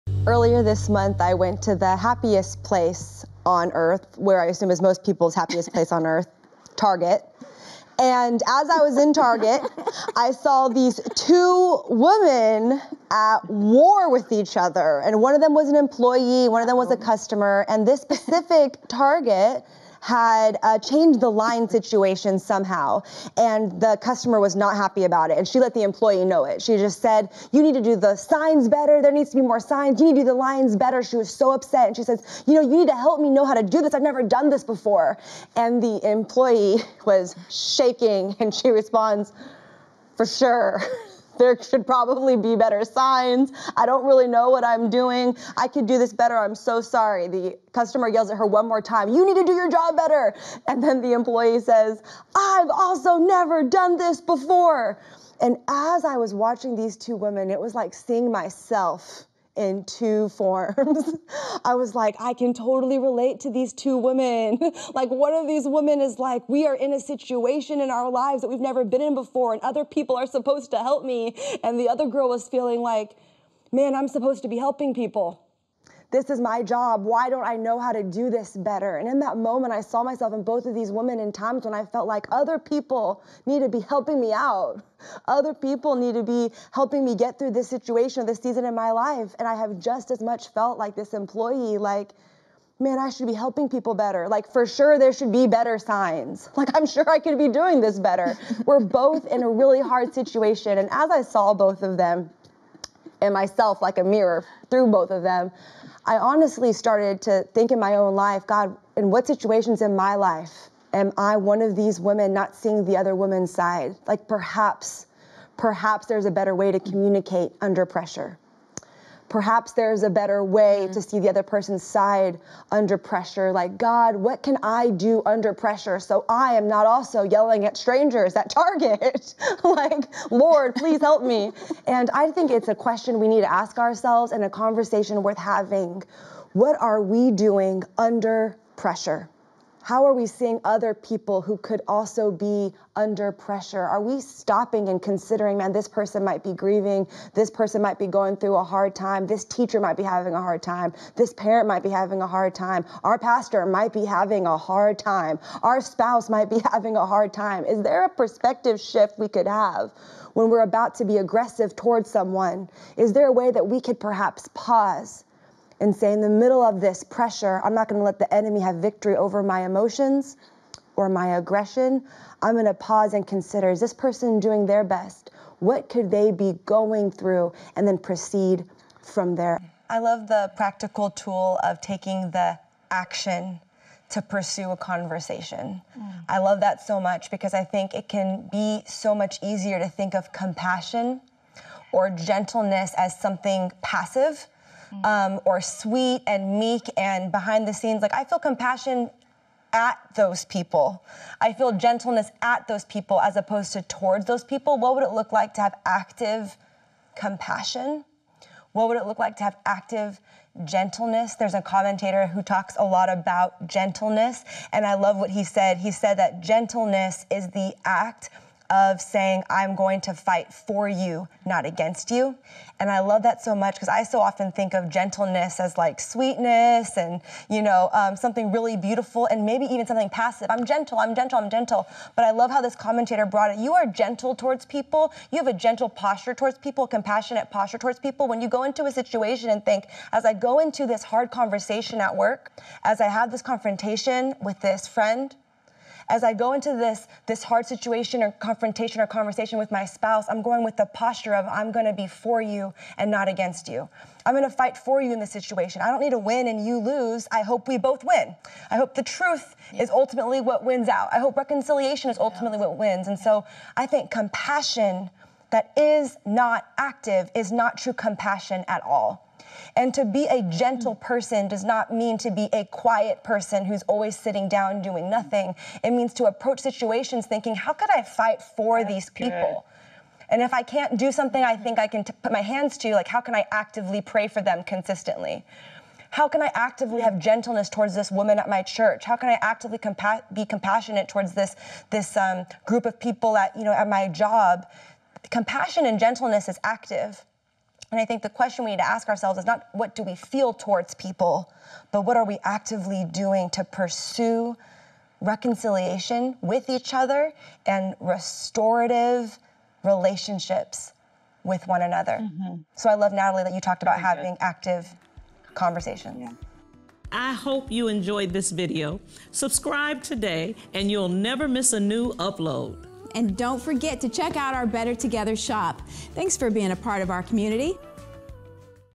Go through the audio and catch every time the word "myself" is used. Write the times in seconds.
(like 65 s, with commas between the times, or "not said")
58 s, 80 s, 103 s.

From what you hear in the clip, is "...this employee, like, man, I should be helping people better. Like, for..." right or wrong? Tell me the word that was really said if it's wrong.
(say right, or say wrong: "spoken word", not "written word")
right.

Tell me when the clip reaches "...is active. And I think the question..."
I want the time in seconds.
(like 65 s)
296 s.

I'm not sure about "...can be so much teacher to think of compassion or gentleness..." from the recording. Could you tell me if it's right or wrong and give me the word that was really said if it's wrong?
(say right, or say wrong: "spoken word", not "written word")
wrong: "easier", not "teacher".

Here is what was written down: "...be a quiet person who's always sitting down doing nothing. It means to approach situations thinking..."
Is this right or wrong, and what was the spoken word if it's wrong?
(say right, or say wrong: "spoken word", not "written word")
right.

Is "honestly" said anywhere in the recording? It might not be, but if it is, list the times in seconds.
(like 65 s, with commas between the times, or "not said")
106 s.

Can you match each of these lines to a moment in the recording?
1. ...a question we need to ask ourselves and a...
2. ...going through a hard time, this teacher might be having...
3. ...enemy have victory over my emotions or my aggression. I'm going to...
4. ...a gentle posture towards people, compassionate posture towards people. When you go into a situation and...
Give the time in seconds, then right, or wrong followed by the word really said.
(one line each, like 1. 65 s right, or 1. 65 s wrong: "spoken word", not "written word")
1. 132 s right
2. 148 s right
3. 168 s right
4. 235 s right.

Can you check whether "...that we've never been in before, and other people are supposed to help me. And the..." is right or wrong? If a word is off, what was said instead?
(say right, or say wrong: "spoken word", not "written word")
right.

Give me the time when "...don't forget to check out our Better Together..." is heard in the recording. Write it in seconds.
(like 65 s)
323 s.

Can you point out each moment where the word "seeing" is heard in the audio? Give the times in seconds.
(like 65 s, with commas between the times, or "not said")
57 s, 112 s, 140 s.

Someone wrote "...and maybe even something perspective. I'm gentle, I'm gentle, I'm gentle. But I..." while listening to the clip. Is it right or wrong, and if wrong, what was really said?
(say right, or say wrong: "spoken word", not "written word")
wrong: "passive", not "perspective".